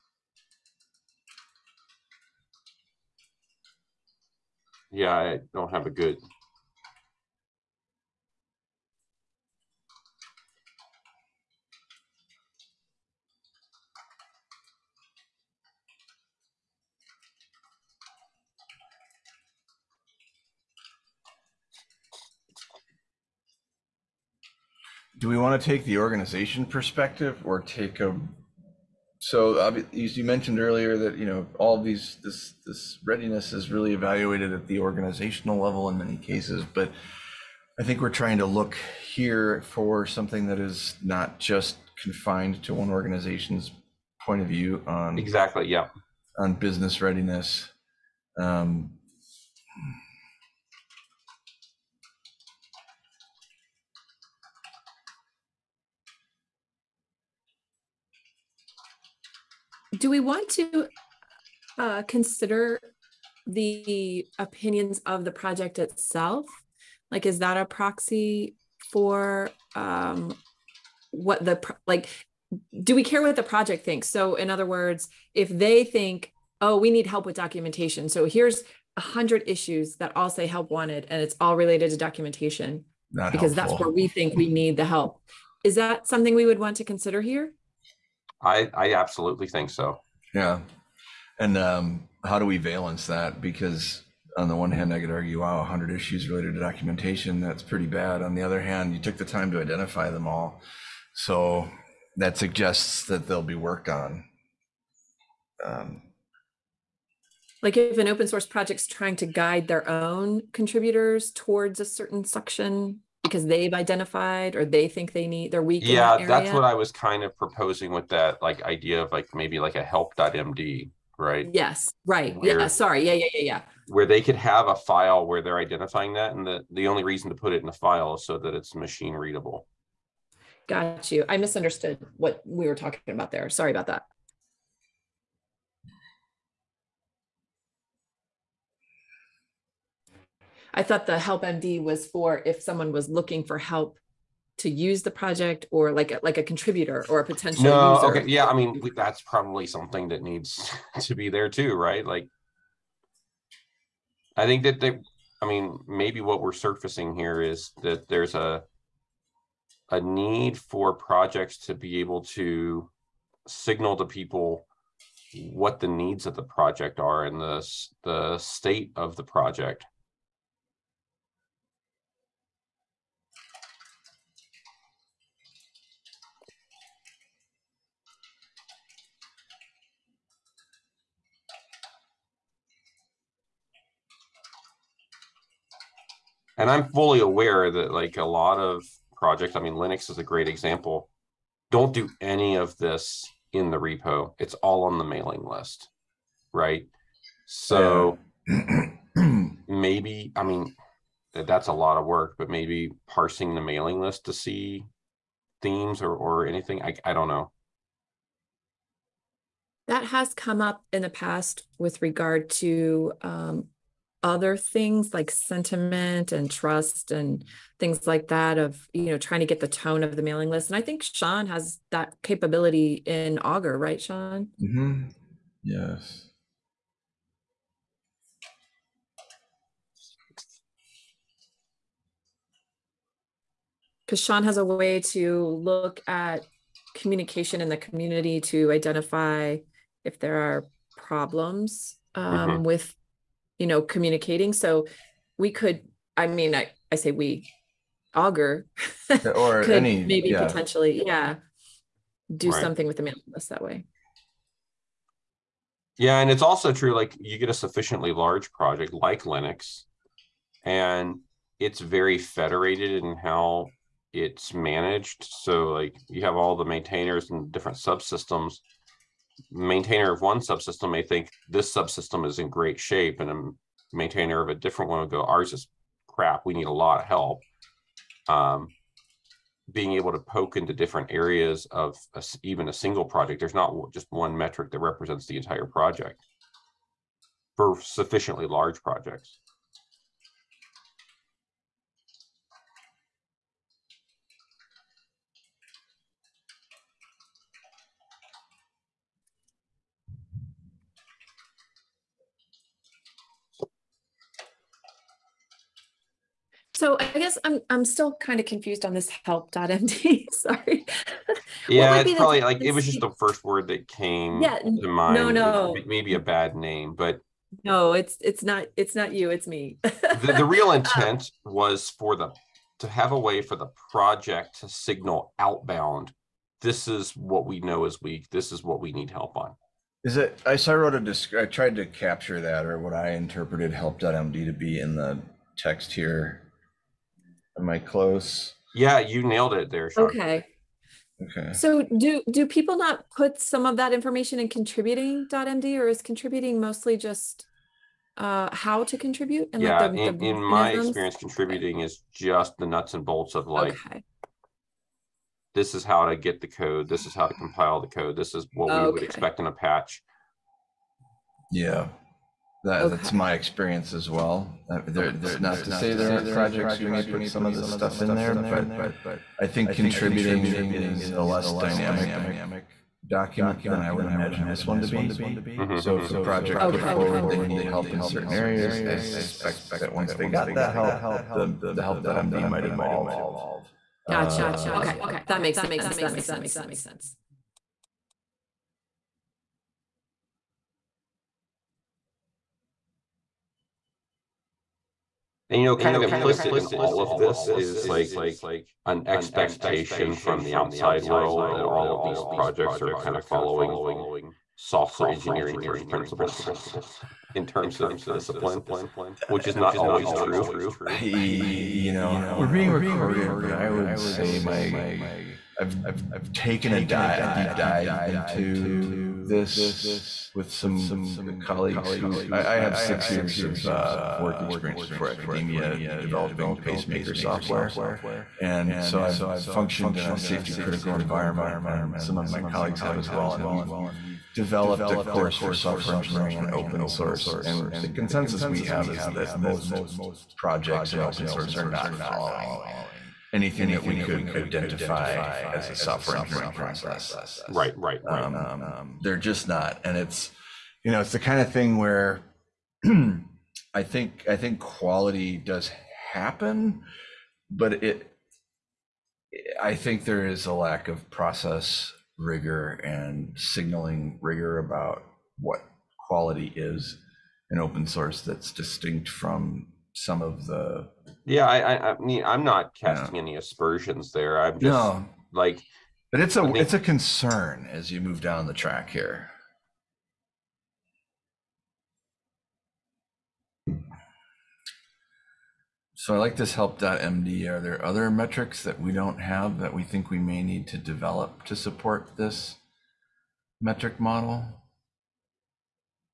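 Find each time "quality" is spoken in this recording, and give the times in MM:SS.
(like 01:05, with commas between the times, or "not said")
07:34, 07:46.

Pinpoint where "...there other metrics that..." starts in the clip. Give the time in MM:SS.
08:07.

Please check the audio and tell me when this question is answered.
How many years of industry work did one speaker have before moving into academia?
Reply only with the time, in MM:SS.
07:02.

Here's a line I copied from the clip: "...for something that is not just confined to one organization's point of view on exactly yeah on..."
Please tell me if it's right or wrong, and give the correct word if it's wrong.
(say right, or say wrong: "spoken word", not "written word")
right.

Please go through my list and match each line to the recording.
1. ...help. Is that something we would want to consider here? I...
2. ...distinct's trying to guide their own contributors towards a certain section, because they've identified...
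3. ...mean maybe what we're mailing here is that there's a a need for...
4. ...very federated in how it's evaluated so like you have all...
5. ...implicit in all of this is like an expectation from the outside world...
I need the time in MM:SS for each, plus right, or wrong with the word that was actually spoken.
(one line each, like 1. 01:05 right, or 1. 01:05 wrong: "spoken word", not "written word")
1. 01:24 right
2. 01:48 wrong: "project", not "distinct"
3. 02:35 wrong: "surfacing", not "mailing"
4. 04:21 wrong: "managed", not "evaluated"
5. 06:36 right.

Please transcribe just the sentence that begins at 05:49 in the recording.
And yeah, like the, in, the in my experience, contributing okay.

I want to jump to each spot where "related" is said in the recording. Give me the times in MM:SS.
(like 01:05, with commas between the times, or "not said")
01:21, 01:36.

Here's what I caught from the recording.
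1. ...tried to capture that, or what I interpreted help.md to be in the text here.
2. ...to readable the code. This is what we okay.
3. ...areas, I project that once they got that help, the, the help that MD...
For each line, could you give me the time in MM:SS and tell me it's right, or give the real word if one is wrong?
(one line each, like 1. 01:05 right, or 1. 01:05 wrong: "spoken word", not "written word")
1. 05:31 right
2. 05:57 wrong: "compile", not "readable"
3. 06:18 wrong: "suspect", not "project".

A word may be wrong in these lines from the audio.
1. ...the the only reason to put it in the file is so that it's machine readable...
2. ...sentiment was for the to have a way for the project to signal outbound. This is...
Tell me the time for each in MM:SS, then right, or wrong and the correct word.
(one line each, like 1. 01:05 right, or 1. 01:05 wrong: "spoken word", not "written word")
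1. 02:06 right
2. 05:20 wrong: "intent", not "sentiment".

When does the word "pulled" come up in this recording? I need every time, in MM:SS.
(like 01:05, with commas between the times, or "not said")
not said.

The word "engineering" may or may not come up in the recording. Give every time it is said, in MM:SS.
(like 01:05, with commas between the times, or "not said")
06:45, 07:15, 07:26.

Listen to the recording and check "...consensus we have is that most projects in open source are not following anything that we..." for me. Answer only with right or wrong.
right.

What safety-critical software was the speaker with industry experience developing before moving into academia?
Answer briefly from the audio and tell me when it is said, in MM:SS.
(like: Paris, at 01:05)
pacemaker software, at 07:06.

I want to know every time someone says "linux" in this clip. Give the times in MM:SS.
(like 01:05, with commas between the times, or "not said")
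03:09, 04:19.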